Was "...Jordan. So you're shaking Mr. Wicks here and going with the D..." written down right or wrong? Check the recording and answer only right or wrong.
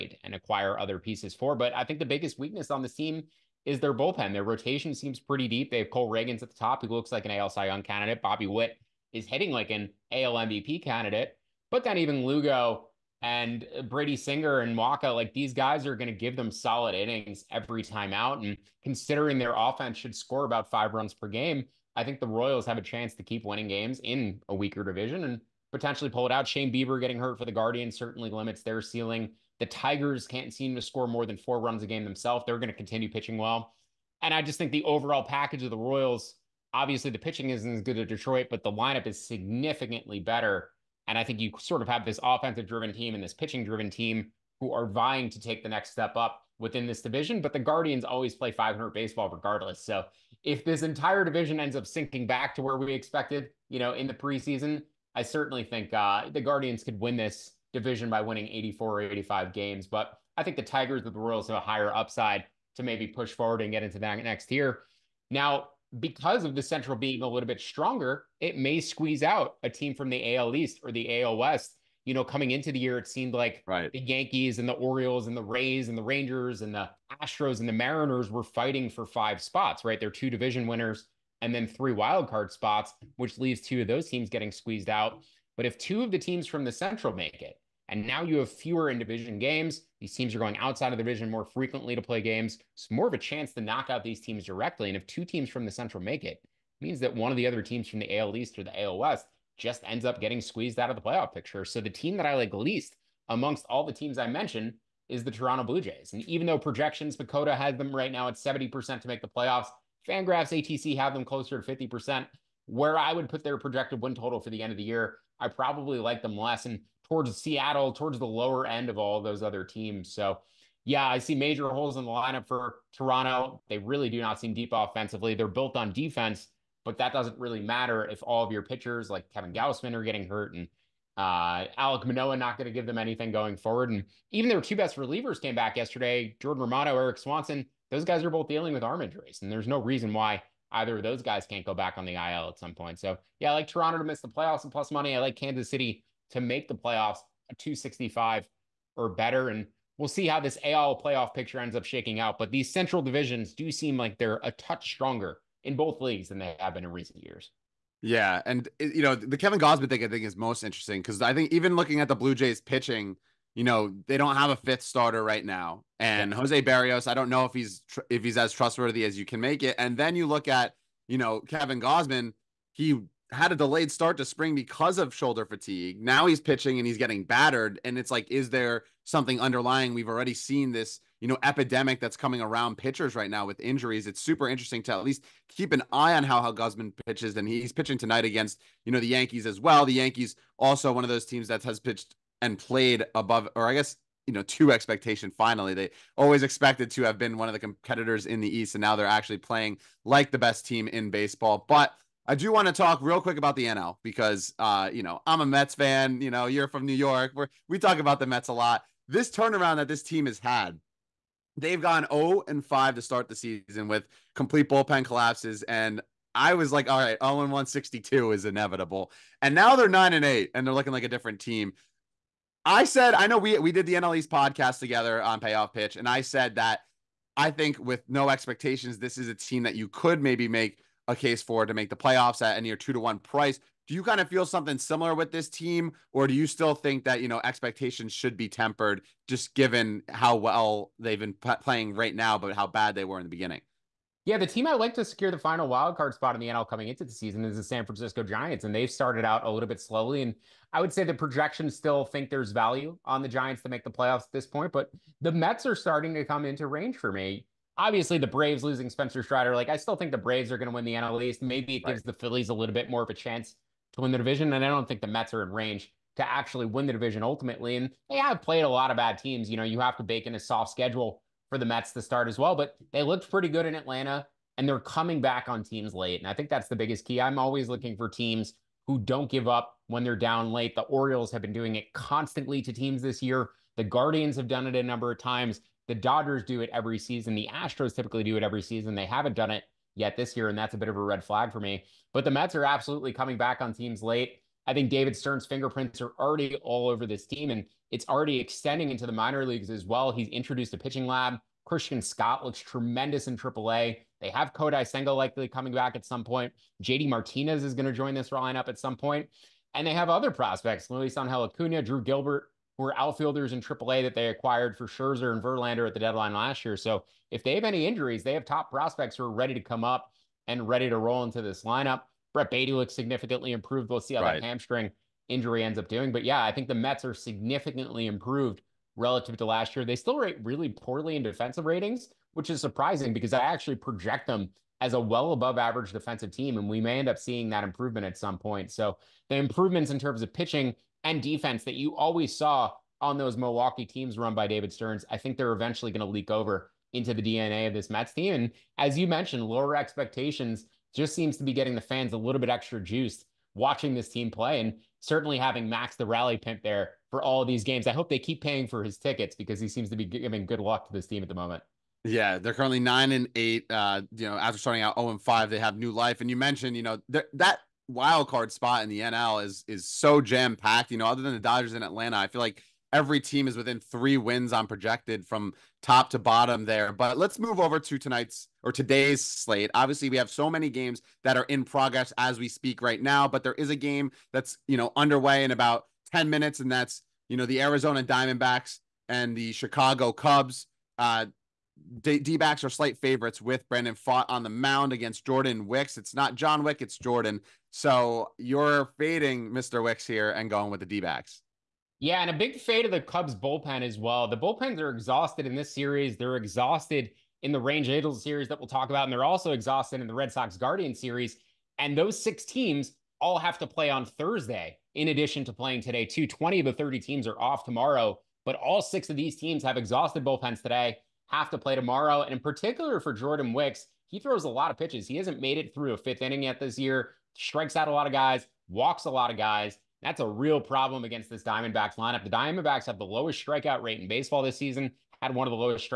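wrong.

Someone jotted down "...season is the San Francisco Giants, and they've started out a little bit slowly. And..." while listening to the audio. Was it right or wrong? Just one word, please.
right.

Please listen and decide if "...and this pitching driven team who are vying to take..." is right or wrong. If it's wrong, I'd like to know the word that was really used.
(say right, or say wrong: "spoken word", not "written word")
right.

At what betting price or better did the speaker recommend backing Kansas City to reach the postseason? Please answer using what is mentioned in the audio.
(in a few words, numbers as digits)
265.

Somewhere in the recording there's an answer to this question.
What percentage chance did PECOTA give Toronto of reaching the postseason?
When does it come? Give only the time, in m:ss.
1:48.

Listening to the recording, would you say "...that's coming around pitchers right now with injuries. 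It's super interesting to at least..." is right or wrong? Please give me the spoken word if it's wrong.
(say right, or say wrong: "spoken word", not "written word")
right.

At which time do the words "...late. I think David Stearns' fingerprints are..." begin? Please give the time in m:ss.
4:54.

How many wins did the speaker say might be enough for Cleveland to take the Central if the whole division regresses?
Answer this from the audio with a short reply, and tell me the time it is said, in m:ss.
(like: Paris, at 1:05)
84 or 85, at 0:58.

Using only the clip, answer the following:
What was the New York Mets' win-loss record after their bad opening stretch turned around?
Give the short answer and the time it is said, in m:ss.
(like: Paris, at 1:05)
9 and 8, at 3:39.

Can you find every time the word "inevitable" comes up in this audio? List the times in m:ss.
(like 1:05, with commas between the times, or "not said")
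3:38.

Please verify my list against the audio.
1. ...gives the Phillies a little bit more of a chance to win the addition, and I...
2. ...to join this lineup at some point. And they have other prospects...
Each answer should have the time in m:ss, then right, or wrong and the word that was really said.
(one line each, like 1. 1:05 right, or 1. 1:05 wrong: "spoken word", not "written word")
1. 4:21 wrong: "division", not "addition"
2. 5:07 right.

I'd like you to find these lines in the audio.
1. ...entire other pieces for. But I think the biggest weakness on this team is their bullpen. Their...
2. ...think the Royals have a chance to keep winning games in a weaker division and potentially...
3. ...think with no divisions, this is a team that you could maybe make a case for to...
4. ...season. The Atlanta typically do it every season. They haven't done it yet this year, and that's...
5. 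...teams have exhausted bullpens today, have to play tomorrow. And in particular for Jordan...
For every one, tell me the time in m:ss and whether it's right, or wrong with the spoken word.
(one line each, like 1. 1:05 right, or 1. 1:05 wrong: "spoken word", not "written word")
1. 0:00 wrong: "acquire", not "entire"
2. 0:22 right
3. 3:47 wrong: "expectations", not "divisions"
4. 4:46 wrong: "Astros", not "Atlanta"
5. 6:59 right.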